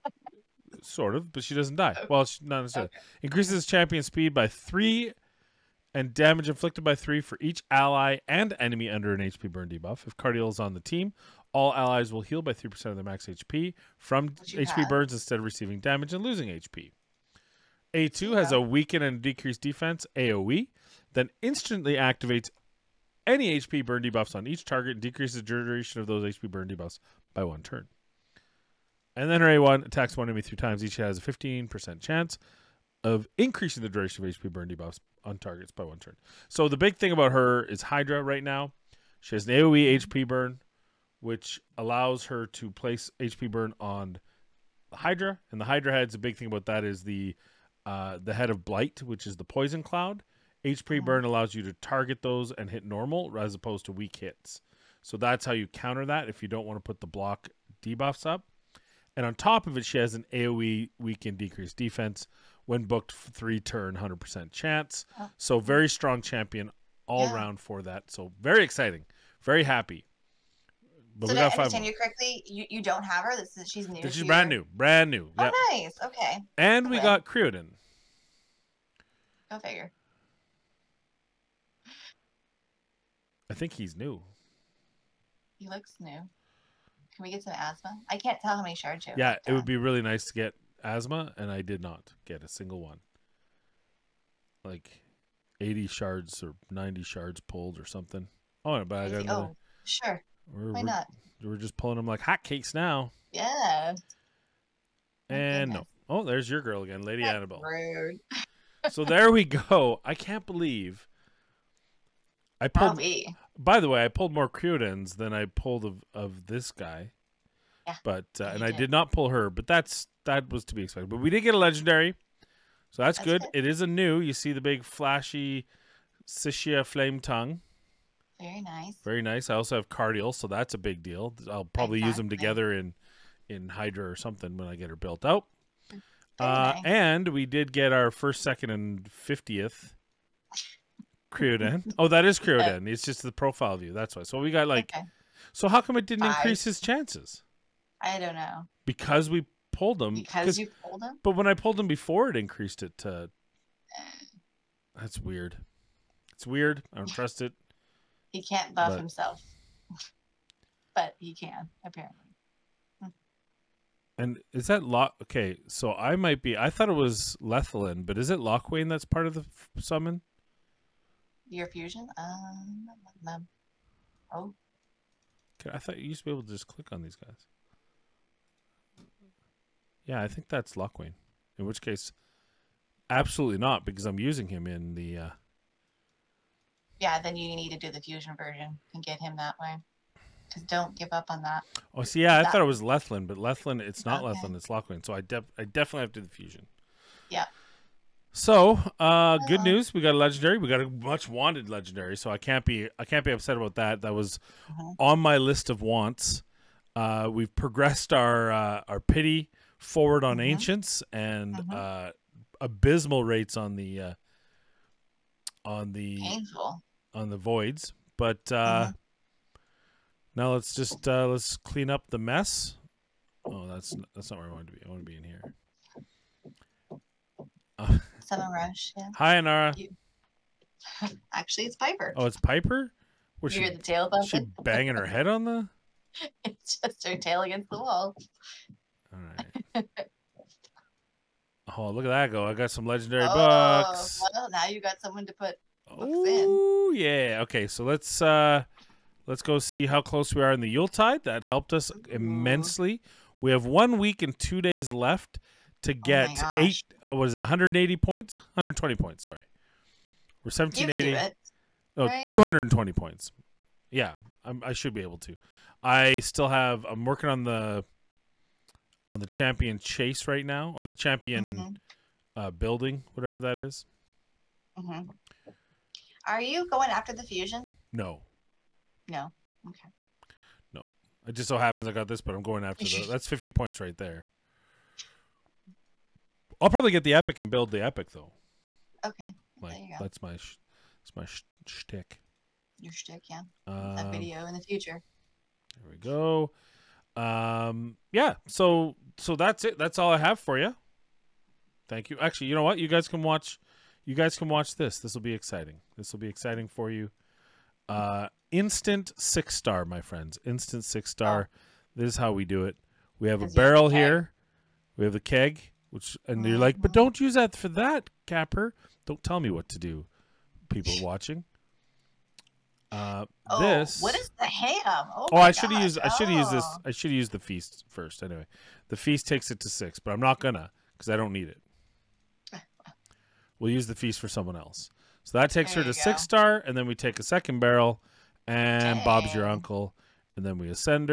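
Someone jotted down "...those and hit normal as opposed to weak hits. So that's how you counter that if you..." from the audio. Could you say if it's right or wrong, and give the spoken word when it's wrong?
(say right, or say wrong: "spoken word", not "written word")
right.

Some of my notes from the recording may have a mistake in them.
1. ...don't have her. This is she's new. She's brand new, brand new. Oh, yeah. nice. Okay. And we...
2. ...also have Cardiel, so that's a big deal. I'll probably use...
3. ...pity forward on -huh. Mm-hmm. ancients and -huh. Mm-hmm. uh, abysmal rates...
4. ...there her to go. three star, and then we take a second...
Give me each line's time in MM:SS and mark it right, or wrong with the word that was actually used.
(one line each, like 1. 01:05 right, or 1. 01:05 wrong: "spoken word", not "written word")
1. 01:12 right
2. 02:09 right
3. 03:28 right
4. 05:35 wrong: "six", not "three".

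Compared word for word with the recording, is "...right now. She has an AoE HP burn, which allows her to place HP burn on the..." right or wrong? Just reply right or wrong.
right.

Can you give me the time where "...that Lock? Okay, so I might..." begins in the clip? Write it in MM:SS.
02:44.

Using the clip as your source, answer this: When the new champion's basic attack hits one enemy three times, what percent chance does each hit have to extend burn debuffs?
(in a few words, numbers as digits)
15%.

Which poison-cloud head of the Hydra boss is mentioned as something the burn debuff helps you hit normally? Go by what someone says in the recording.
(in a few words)
Blight.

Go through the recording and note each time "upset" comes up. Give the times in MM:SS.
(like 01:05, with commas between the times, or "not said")
03:23.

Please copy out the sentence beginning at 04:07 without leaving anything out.
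Okay, so let's uh let's go see how close we are in the Yuletide.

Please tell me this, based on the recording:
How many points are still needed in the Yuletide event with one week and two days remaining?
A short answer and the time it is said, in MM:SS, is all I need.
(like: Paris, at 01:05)
220, at 04:22.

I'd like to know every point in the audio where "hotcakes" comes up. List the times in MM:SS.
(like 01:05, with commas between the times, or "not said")
01:42.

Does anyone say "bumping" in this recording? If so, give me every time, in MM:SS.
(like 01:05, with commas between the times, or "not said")
03:54.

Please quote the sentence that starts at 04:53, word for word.
Um, that video in the future.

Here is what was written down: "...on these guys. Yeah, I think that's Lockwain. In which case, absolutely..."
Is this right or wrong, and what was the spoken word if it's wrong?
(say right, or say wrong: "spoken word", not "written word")
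right.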